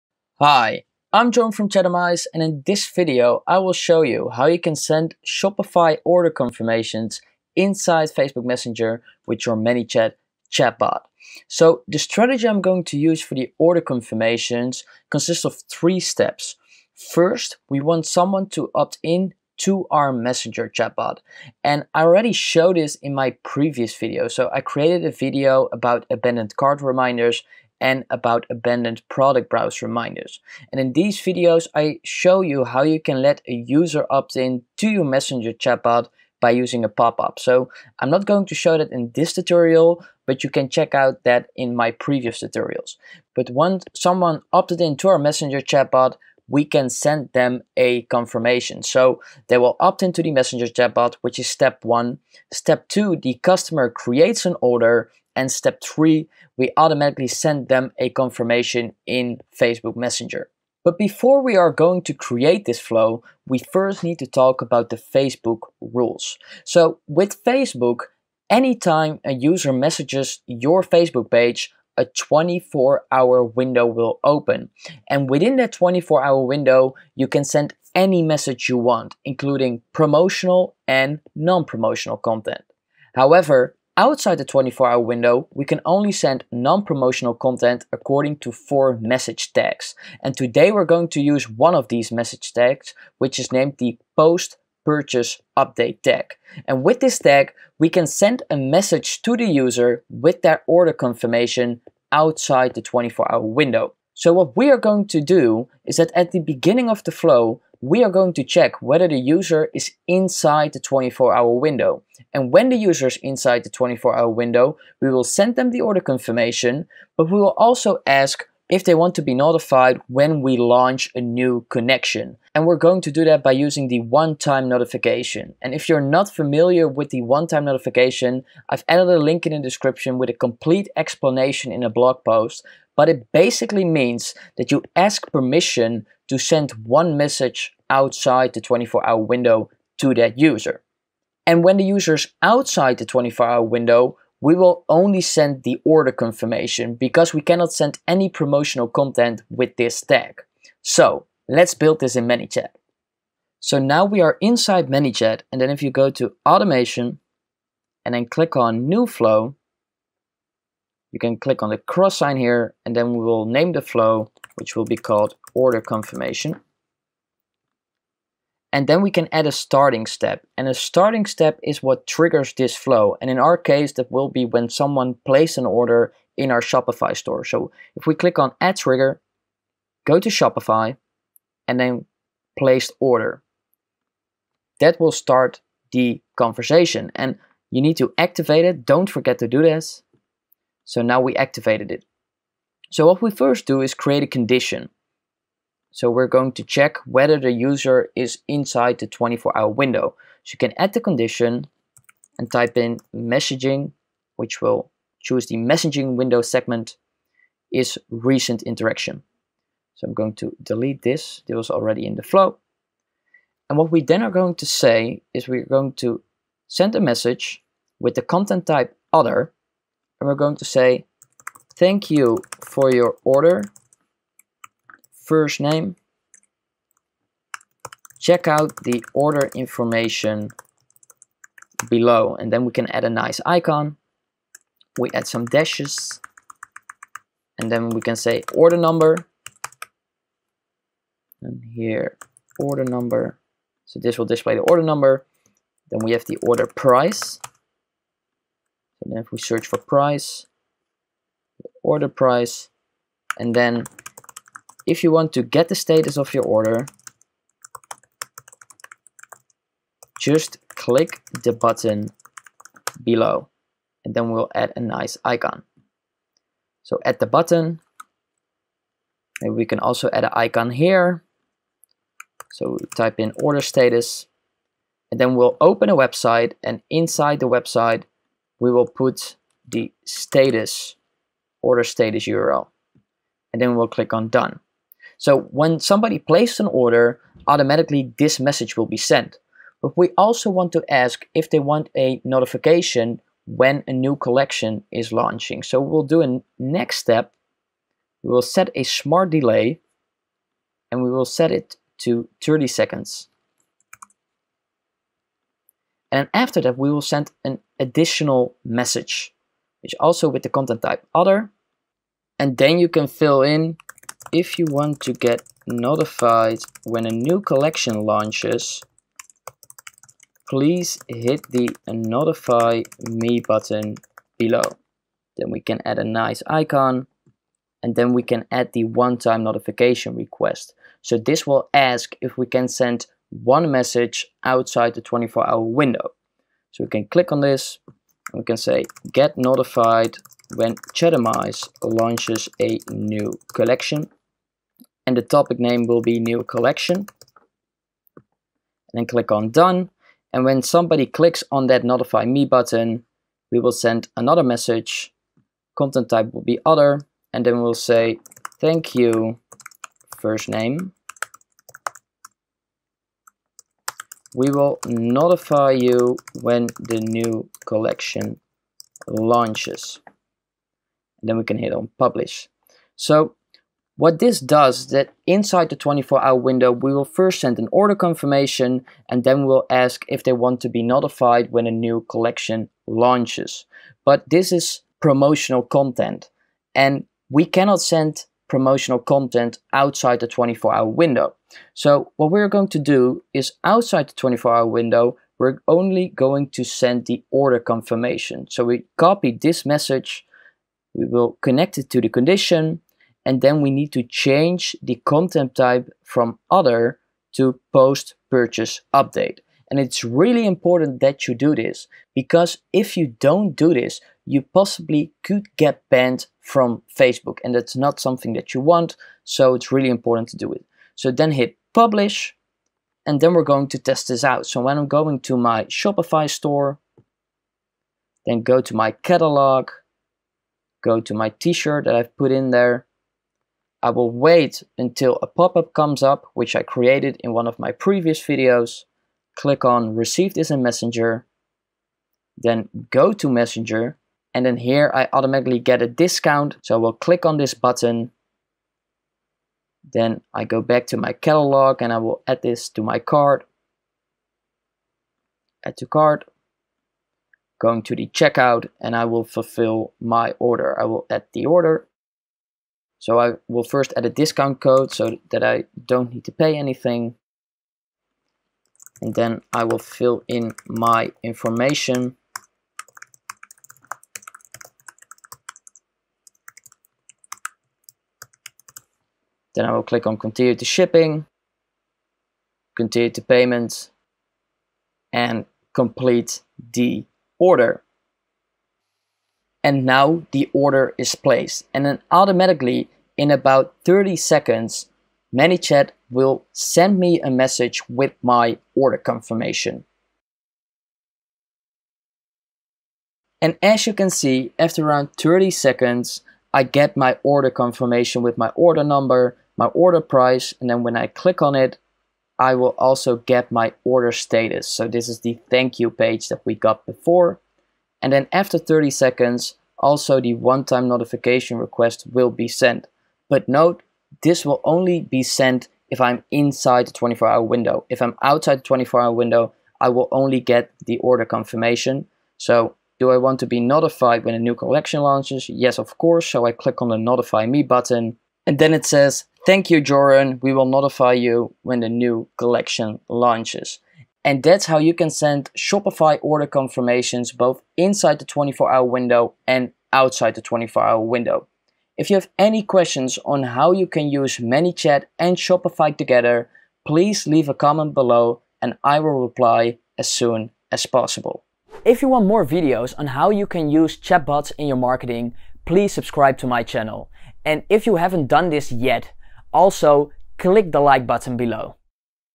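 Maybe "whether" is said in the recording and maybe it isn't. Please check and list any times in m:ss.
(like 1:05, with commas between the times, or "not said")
1:48, 3:17.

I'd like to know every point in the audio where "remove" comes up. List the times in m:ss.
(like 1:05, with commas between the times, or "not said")
not said.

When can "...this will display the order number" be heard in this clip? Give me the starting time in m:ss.
4:03.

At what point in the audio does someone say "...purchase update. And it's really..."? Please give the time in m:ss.
6:48.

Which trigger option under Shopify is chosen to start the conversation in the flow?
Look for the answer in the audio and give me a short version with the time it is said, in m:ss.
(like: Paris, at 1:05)
placed order, at 3:02.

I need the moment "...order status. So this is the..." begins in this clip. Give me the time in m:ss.
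8:33.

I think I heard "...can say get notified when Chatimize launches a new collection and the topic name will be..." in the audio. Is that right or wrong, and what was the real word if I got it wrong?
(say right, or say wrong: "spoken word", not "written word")
right.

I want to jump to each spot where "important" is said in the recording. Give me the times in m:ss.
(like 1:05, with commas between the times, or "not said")
6:50, 6:59.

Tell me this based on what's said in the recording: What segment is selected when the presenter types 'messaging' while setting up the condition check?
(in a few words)
recent interaction.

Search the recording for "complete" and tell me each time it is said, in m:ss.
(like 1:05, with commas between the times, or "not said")
2:10, 8:05.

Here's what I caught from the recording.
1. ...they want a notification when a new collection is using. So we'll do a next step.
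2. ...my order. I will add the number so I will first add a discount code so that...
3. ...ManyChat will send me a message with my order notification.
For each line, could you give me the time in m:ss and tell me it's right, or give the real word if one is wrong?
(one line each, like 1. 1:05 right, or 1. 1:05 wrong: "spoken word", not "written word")
1. 4:51 wrong: "launching", not "using"
2. 7:40 wrong: "order", not "number"
3. 8:15 wrong: "confirmation", not "notification".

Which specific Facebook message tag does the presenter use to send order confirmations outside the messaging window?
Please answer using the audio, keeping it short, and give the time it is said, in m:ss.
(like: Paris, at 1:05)
post purchase update tag, at 1:34.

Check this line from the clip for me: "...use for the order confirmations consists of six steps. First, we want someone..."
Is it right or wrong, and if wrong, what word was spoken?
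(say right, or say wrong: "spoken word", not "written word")
wrong: "three", not "six".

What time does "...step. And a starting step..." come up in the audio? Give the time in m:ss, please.
2:50.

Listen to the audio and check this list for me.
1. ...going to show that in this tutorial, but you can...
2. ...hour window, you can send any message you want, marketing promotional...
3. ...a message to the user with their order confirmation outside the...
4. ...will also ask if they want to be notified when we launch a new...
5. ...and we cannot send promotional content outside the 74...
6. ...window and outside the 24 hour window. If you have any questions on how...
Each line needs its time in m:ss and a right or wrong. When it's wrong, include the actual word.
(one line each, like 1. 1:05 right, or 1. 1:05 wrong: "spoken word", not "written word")
1. 0:38 right
2. 1:16 wrong: "including", not "marketing"
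3. 1:38 right
4. 1:57 right
5. 6:26 wrong: "24", not "74"
6. 9:08 right.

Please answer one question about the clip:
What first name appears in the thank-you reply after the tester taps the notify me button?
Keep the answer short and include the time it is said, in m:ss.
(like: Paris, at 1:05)
Joren, at 8:59.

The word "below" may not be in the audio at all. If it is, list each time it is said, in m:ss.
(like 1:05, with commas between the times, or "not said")
3:51, 4:23, 5:24, 9:17, 9:31.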